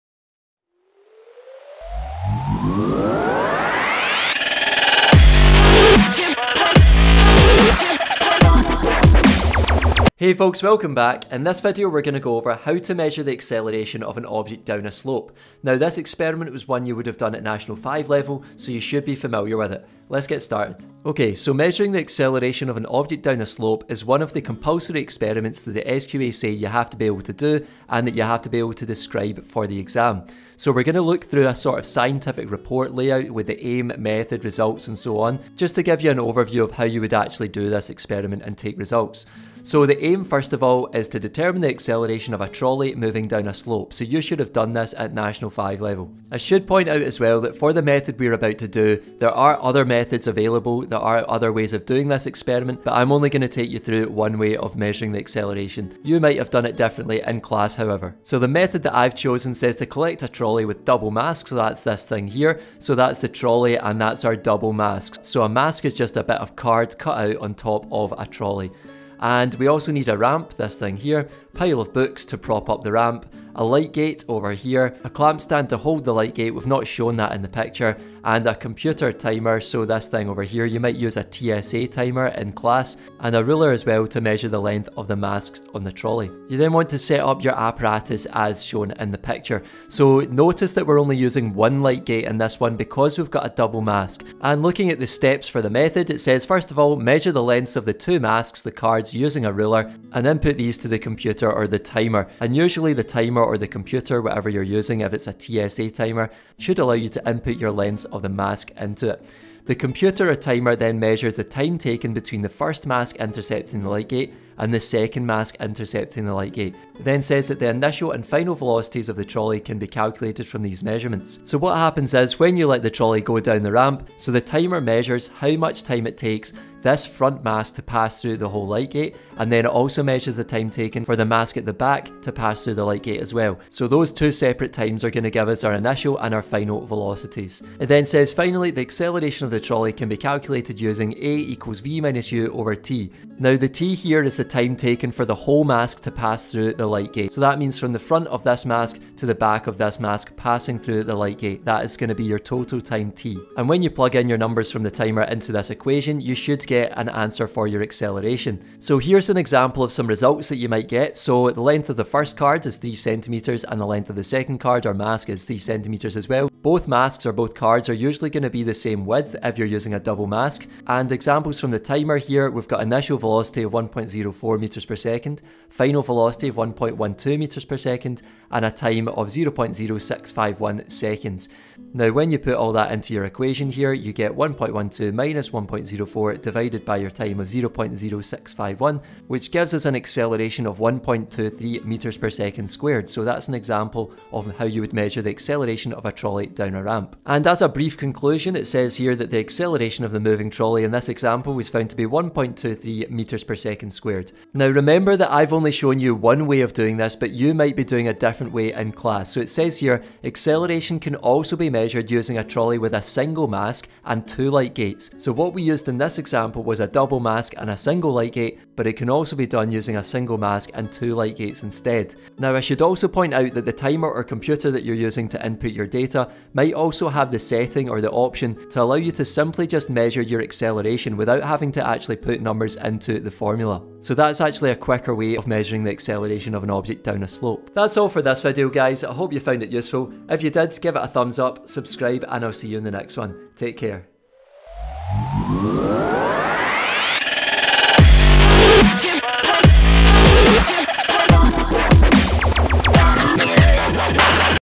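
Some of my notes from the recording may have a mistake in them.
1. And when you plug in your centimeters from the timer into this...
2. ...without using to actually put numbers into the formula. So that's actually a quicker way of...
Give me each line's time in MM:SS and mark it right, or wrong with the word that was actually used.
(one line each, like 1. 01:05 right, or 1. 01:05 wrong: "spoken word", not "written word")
1. 02:33 wrong: "numbers", not "centimeters"
2. 03:51 wrong: "having", not "using".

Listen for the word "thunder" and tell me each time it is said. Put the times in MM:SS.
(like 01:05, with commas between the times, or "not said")
not said.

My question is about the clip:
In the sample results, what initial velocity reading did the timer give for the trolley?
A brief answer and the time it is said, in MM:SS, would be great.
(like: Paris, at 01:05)
1.04 m/s, at 02:53.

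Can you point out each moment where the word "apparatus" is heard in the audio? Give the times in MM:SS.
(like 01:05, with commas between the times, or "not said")
01:27.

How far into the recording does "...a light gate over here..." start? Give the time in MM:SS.
01:13.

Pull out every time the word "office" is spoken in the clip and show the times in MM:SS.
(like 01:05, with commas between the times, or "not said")
not said.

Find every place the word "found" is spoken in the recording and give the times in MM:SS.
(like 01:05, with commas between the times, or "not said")
03:21, 03:59.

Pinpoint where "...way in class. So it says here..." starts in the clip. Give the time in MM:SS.
03:28.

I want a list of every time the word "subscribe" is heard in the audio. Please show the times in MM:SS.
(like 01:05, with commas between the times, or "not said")
04:01.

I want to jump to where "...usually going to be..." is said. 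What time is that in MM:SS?
02:48.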